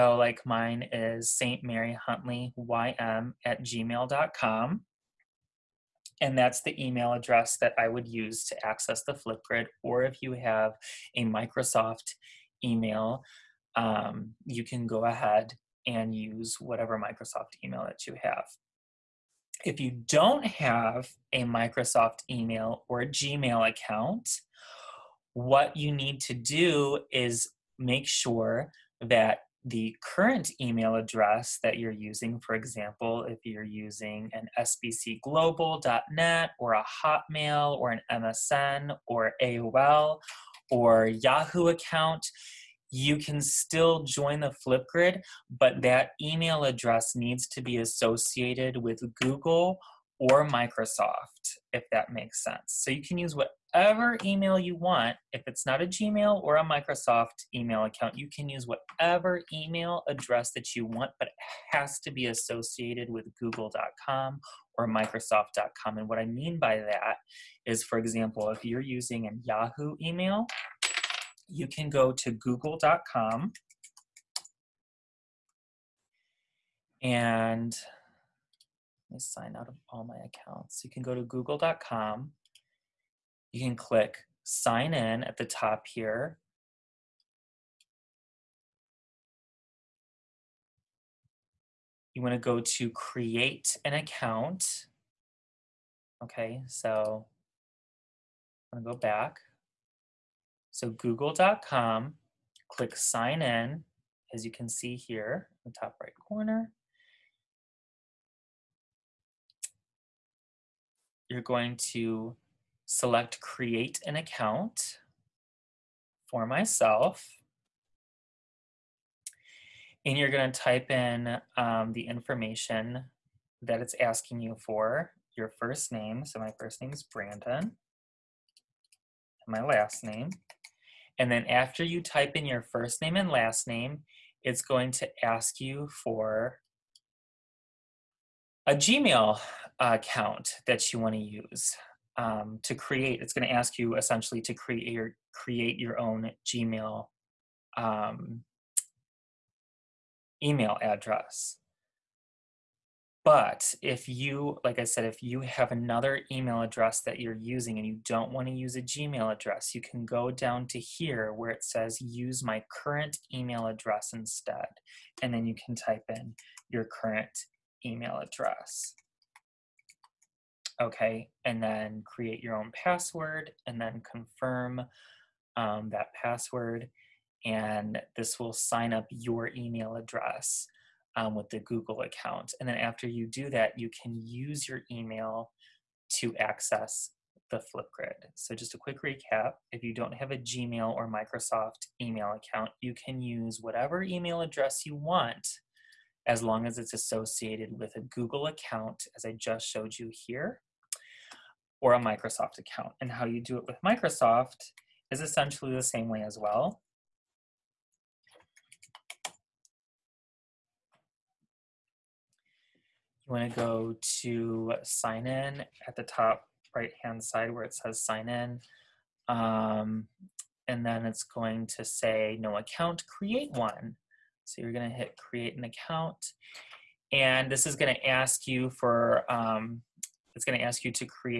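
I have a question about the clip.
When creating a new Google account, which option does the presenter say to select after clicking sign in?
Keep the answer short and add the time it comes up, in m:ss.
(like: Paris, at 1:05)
Create an account for myself, at 1:53.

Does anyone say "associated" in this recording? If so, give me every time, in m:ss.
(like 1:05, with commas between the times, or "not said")
0:47, 1:02, 3:16.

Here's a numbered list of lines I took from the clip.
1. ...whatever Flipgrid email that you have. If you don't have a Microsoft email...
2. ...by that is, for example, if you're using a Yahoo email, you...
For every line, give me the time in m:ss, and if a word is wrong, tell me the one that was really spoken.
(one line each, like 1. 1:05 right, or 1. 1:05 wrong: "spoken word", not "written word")
1. 0:16 wrong: "Microsoft", not "Flipgrid"
2. 1:06 right.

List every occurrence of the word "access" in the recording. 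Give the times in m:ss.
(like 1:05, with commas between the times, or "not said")
0:08, 3:06.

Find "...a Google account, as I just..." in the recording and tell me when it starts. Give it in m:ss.
3:17.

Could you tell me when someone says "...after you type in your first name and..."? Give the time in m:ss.
2:11.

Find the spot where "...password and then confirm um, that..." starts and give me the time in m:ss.
2:52.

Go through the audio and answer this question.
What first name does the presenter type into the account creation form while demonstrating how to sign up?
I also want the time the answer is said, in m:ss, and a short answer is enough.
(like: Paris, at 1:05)
Brandon, at 2:07.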